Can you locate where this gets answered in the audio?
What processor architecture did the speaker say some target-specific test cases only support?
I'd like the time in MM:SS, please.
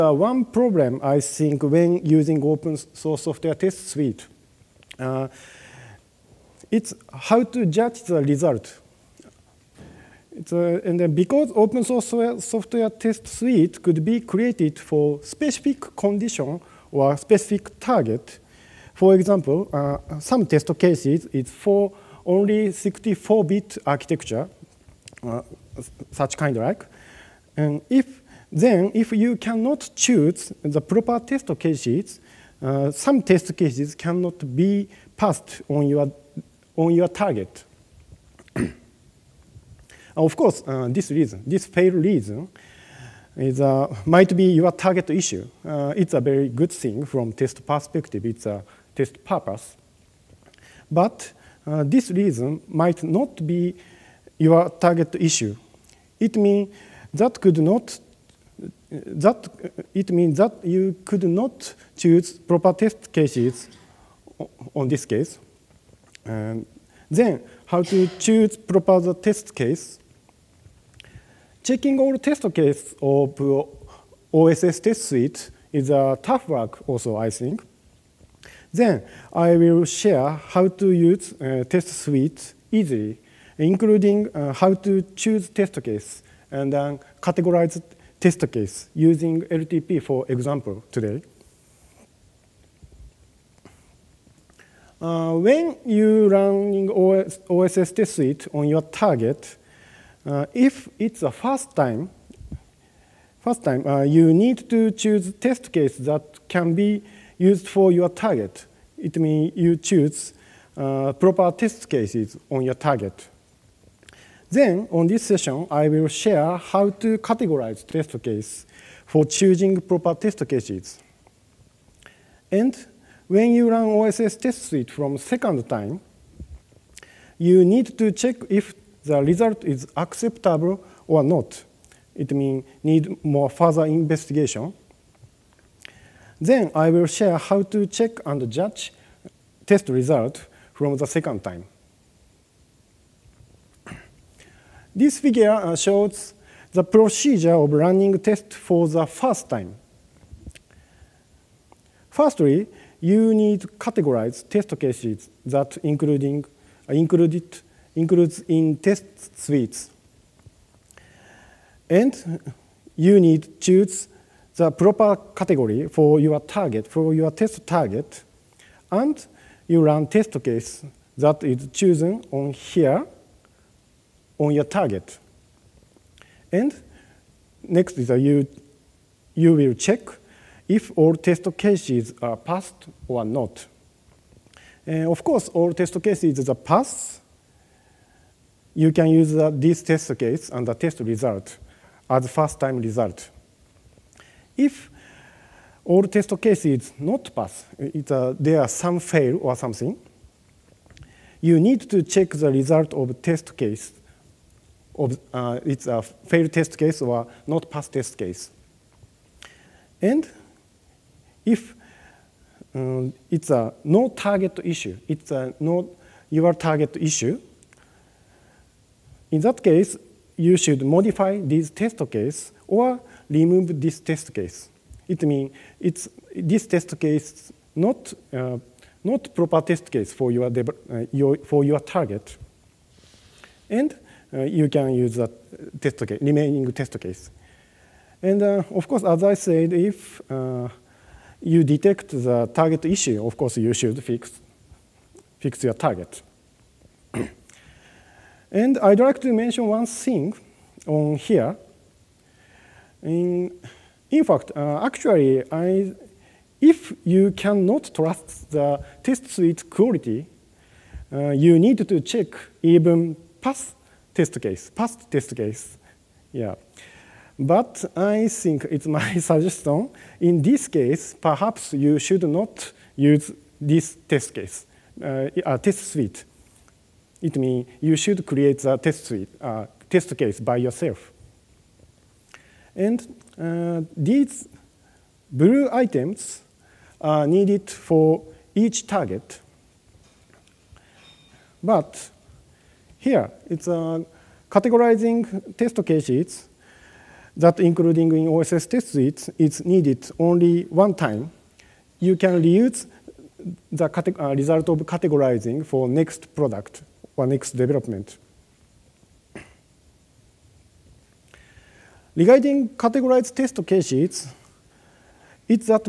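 00:22.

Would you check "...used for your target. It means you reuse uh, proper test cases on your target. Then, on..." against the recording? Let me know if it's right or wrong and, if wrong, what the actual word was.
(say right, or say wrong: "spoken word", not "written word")
wrong: "choose", not "reuse".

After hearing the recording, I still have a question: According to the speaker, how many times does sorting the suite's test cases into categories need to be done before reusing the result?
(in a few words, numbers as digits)
Only one time.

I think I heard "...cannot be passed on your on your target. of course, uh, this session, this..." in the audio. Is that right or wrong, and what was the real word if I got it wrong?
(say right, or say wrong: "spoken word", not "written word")
wrong: "reason", not "session".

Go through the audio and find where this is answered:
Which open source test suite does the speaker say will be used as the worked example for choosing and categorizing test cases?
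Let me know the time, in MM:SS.
01:29.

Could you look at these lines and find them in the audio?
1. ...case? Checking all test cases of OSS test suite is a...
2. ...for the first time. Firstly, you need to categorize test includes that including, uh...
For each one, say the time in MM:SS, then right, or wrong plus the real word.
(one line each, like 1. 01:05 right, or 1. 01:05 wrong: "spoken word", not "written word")
1. 01:09 right
2. 02:28 wrong: "cases", not "includes".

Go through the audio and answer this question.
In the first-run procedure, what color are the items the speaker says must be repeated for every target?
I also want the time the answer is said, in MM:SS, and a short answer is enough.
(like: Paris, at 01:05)
Blue, at 04:45.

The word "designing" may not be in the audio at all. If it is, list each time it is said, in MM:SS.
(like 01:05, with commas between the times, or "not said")
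not said.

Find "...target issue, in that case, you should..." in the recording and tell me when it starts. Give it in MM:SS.
03:36.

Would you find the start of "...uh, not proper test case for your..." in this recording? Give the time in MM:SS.
03:48.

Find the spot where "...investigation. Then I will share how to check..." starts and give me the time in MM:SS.
02:13.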